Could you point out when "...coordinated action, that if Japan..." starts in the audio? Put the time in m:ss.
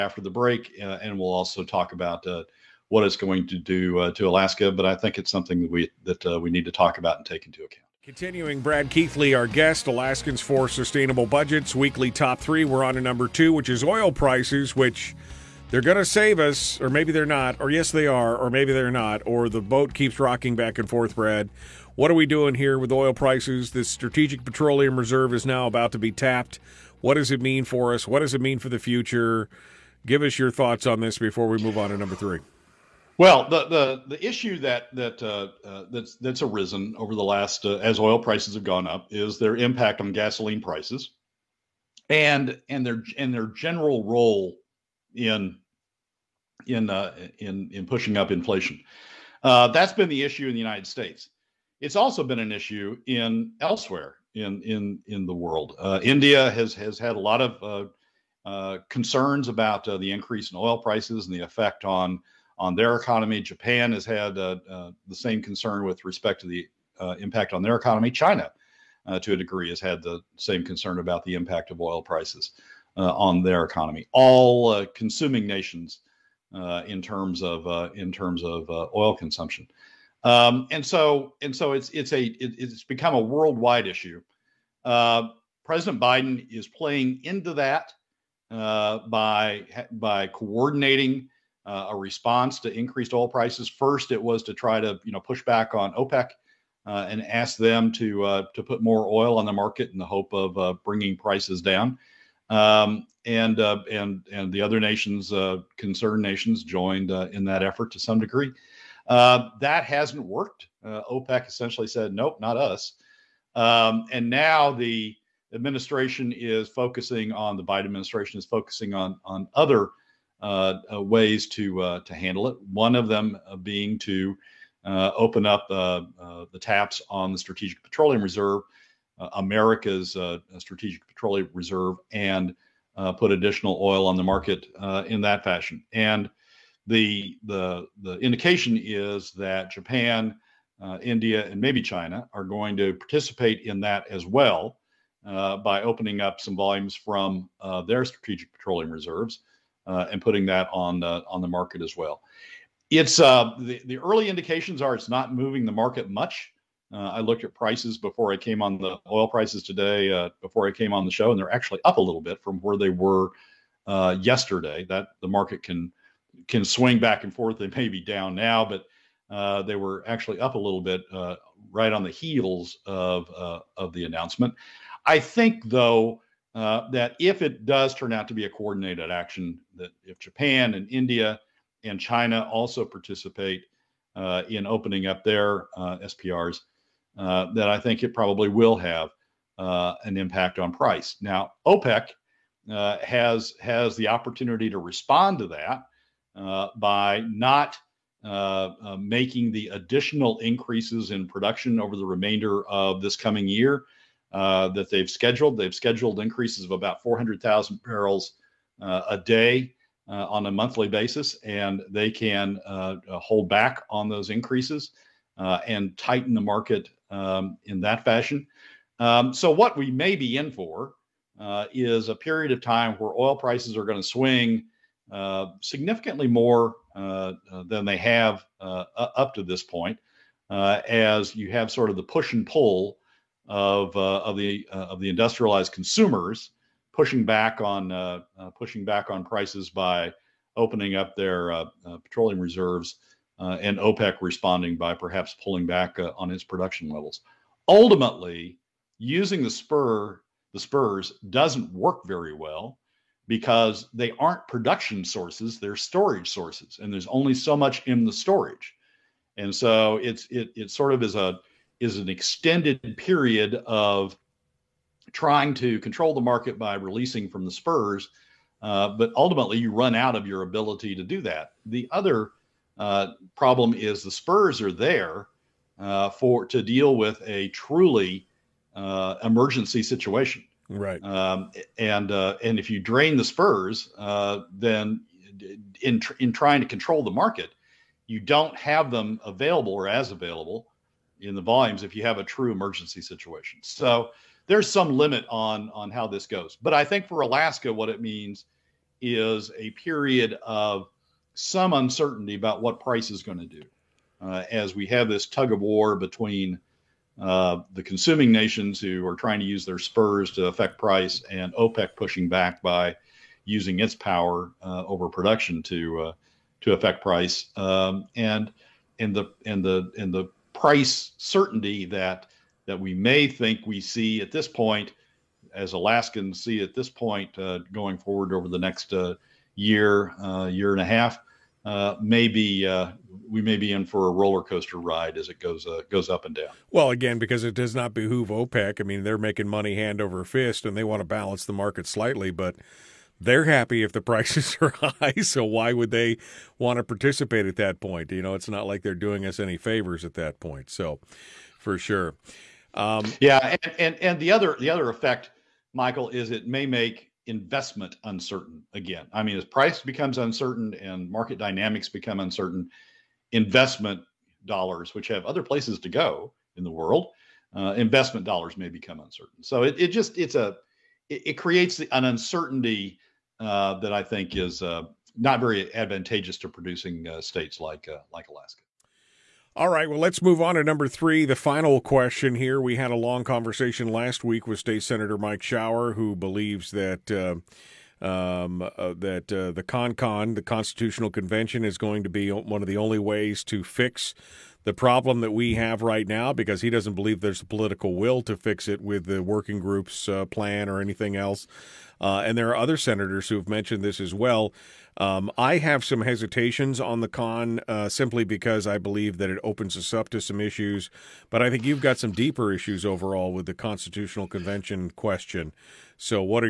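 2:58.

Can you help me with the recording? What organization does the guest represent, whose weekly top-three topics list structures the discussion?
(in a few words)
Alaskans for Sustainable Budgets.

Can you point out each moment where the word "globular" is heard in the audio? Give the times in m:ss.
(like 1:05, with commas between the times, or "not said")
not said.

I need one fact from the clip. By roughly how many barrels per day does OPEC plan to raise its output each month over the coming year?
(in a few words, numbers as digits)
400,000.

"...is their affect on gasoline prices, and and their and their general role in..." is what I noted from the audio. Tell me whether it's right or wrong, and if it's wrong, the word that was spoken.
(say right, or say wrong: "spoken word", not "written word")
wrong: "impact", not "affect".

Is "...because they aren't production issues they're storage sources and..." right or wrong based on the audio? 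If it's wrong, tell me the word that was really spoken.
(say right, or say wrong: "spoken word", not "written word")
wrong: "sources", not "issues".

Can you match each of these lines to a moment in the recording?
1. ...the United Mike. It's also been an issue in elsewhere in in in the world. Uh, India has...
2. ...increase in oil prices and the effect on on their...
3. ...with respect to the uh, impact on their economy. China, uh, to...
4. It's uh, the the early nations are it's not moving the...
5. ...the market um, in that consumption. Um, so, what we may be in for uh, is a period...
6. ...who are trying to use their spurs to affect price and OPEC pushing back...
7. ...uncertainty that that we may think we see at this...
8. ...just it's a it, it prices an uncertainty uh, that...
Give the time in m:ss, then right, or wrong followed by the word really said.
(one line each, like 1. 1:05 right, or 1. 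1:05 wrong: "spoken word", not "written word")
1. 0:50 wrong: "States", not "Mike"
2. 1:00 right
3. 1:05 right
4. 2:32 wrong: "indications", not "nations"
5. 3:36 wrong: "fashion", not "consumption"
6. 5:08 right
7. 5:21 wrong: "certainty", not "uncertainty"
8. 6:09 wrong: "creates", not "prices".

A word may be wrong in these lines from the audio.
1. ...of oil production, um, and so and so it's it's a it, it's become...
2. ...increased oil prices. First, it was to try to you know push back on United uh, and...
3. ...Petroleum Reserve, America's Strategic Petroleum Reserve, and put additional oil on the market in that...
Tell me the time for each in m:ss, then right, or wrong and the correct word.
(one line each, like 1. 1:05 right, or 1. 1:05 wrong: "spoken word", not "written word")
1. 1:18 wrong: "consumption", not "production"
2. 1:32 wrong: "OPEC", not "United"
3. 2:07 right.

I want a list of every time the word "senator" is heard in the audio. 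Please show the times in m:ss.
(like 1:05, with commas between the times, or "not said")
6:24, 6:42.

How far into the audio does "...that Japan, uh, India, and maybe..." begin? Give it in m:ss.
2:19.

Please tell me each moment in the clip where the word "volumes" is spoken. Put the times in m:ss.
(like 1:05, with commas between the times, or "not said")
2:26, 4:51.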